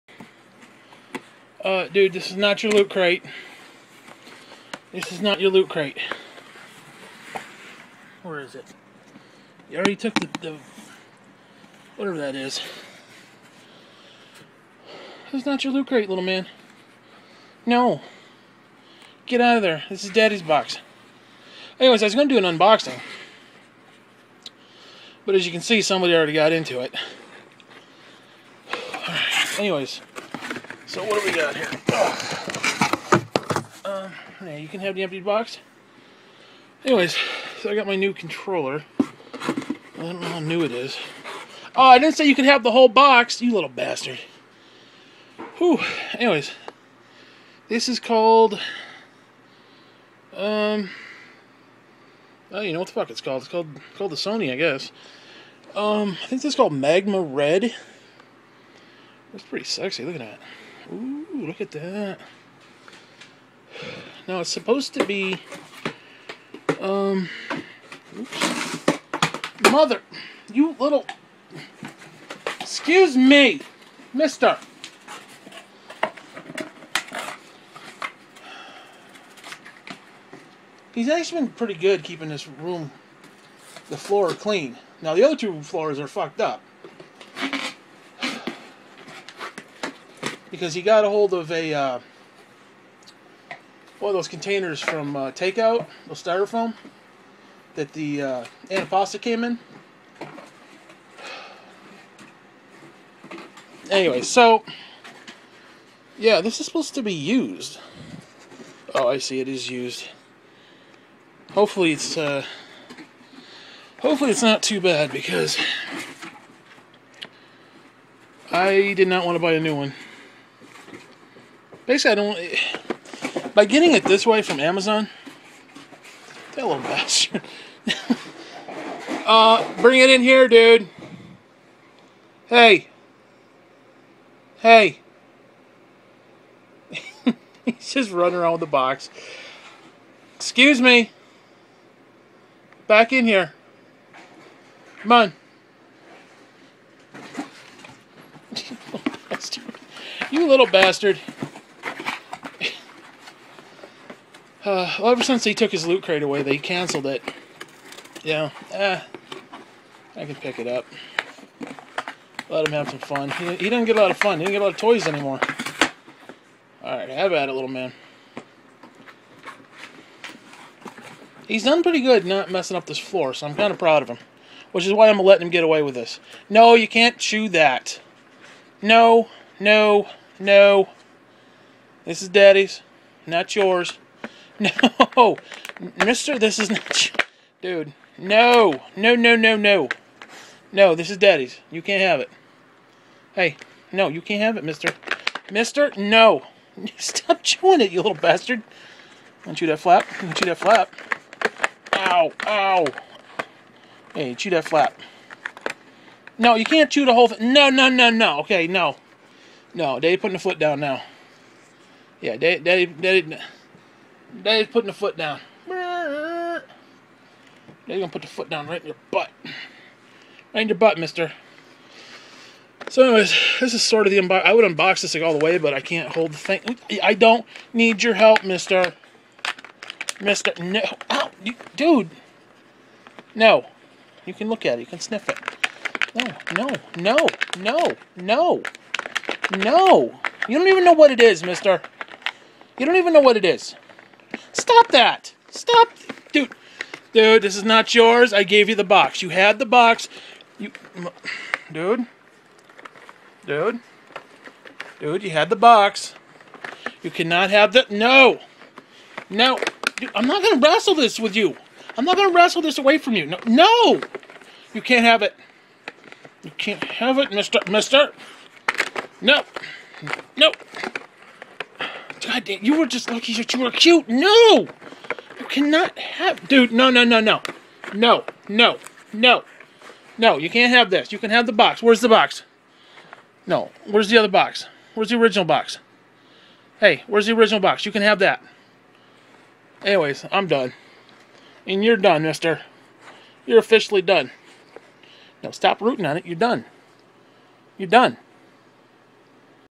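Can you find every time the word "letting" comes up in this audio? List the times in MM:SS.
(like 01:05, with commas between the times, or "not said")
02:55.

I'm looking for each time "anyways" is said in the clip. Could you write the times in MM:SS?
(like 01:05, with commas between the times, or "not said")
00:21, 00:29, 00:36, 00:46, 01:43, 03:43, 04:49.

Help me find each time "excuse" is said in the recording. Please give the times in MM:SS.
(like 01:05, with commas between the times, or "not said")
01:12, 02:20.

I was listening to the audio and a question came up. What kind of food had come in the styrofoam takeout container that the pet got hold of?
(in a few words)
antipasta.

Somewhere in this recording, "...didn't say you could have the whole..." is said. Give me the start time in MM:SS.
00:41.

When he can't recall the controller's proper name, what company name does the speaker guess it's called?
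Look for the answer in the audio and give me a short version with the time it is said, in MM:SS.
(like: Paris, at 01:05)
Sony, at 00:54.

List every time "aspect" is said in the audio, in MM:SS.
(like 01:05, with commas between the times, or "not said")
not said.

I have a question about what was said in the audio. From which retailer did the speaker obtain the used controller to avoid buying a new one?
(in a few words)
Amazon.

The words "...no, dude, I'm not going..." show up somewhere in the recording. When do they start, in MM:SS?
04:19.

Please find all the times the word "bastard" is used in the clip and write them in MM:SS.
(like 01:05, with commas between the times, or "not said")
00:43, 02:06, 02:30, 03:18.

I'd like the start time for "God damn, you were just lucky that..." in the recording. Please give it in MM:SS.
04:32.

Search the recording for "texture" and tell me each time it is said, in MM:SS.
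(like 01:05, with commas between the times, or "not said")
not said.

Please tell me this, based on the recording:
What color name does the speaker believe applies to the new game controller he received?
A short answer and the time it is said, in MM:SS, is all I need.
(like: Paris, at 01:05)
Magma Red, at 00:56.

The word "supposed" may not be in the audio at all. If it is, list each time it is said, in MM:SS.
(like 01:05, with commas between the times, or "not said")
01:04, 01:46.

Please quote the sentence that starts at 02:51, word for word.
He's done pretty good not messing up this floor, so I'm kind of proud of him.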